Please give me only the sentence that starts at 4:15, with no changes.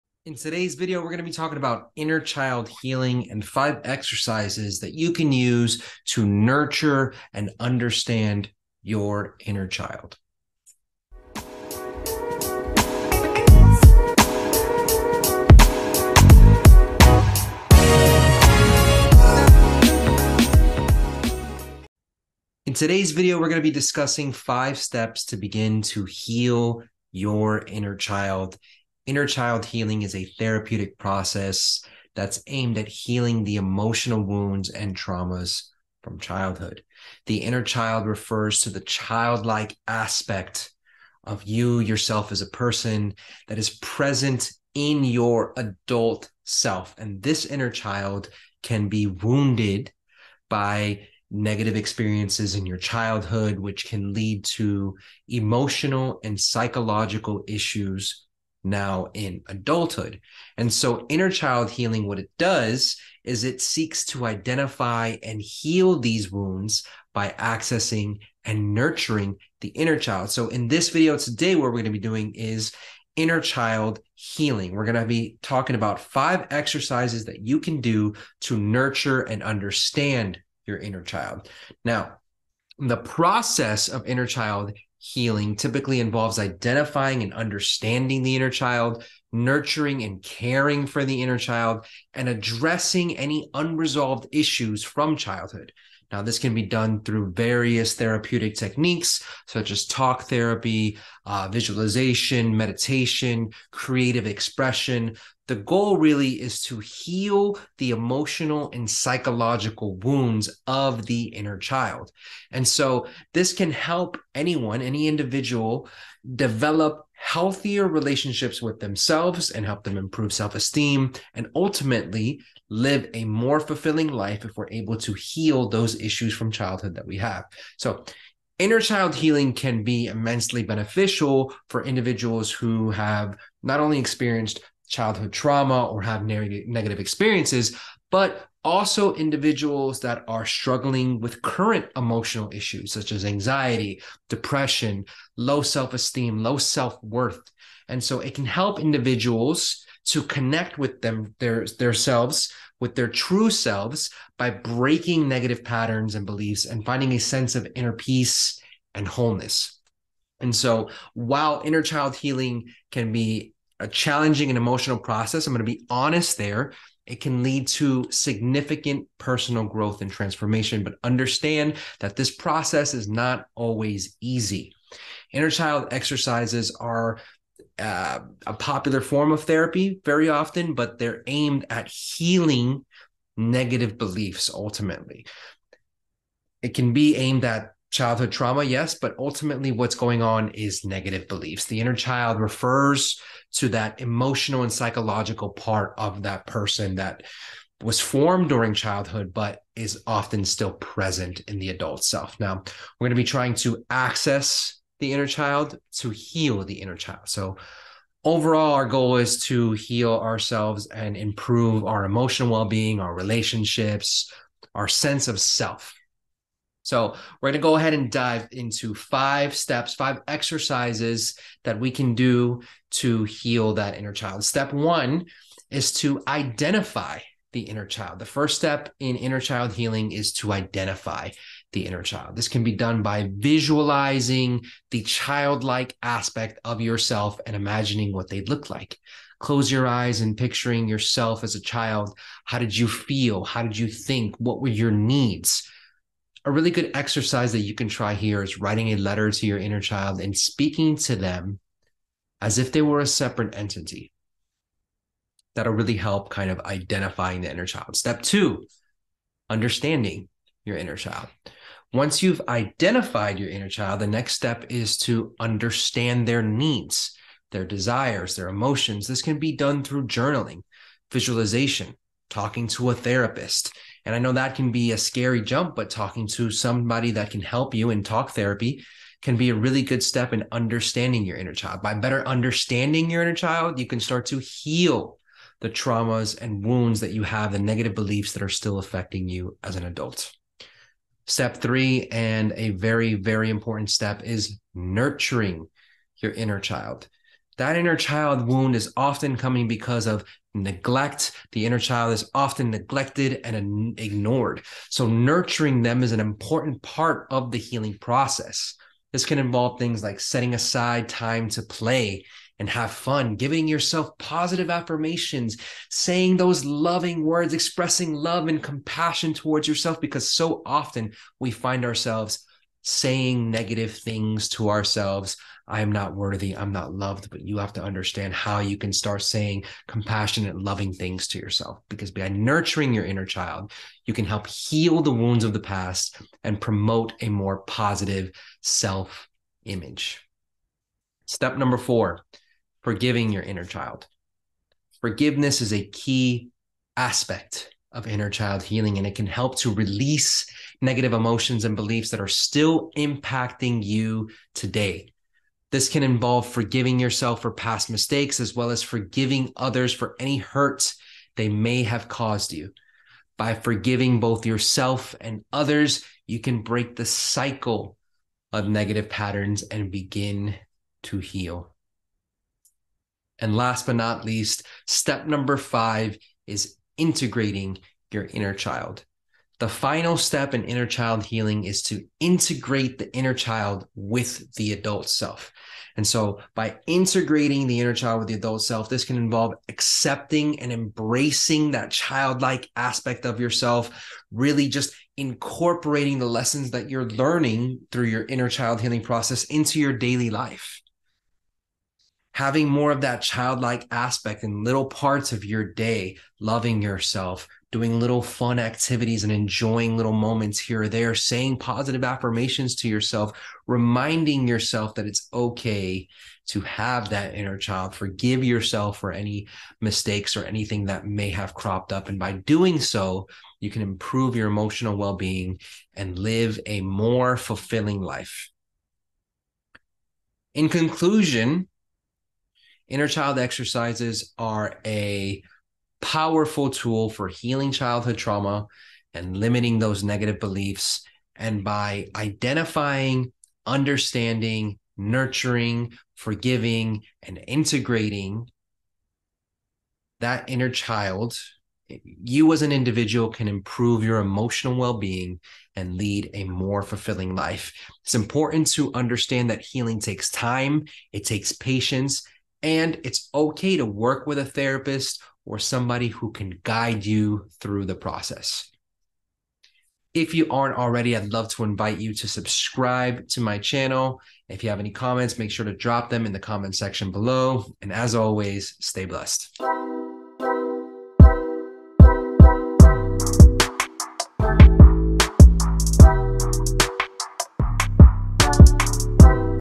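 That'll really help kind of identifying the inner child.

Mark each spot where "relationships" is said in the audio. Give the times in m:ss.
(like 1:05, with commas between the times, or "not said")
1:57, 3:33.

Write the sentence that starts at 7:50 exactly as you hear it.
If you aren't already, I'd love to invite you to subscribe to my channel.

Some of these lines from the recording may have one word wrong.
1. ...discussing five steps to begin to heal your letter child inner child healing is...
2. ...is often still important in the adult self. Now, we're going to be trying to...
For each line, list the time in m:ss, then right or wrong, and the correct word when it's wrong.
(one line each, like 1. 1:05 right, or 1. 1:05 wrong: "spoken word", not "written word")
1. 0:23 wrong: "inner", not "letter"
2. 3:19 wrong: "present", not "important".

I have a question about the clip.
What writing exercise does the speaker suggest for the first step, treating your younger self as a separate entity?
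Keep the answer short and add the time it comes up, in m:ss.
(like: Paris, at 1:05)
writing a letter, at 4:08.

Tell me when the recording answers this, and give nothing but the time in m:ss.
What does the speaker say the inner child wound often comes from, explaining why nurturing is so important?
5:00.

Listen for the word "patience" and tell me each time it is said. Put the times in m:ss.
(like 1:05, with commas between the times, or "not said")
7:41.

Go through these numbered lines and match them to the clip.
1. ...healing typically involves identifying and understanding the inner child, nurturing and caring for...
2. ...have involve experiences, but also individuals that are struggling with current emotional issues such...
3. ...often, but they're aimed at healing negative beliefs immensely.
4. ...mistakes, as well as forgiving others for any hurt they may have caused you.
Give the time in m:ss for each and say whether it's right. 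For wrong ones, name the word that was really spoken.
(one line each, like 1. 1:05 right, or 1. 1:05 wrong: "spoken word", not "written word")
1. 1:25 right
2. 2:16 wrong: "negative", not "involve"
3. 3:00 wrong: "ultimately", not "immensely"
4. 5:57 right.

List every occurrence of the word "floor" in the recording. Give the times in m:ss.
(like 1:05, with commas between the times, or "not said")
not said.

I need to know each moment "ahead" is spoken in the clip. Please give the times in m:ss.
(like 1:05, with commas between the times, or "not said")
3:37.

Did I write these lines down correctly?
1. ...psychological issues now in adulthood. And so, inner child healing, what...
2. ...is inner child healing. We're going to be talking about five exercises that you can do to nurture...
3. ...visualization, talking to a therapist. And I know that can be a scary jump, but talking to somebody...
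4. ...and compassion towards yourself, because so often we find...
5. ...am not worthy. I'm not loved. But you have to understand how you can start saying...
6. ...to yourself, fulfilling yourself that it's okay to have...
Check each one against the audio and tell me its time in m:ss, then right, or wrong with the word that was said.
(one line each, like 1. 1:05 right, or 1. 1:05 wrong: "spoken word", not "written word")
1. 0:56 right
2. 1:12 right
3. 4:31 right
4. 5:18 right
5. 5:25 right
6. 6:52 wrong: "reminding", not "fulfilling".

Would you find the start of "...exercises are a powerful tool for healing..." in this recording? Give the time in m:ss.
7:13.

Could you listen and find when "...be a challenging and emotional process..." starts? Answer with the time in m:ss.
2:43.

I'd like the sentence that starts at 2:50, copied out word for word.
But understand that this process is not always easy.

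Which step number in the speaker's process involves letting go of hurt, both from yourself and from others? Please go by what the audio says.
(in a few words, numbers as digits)
4.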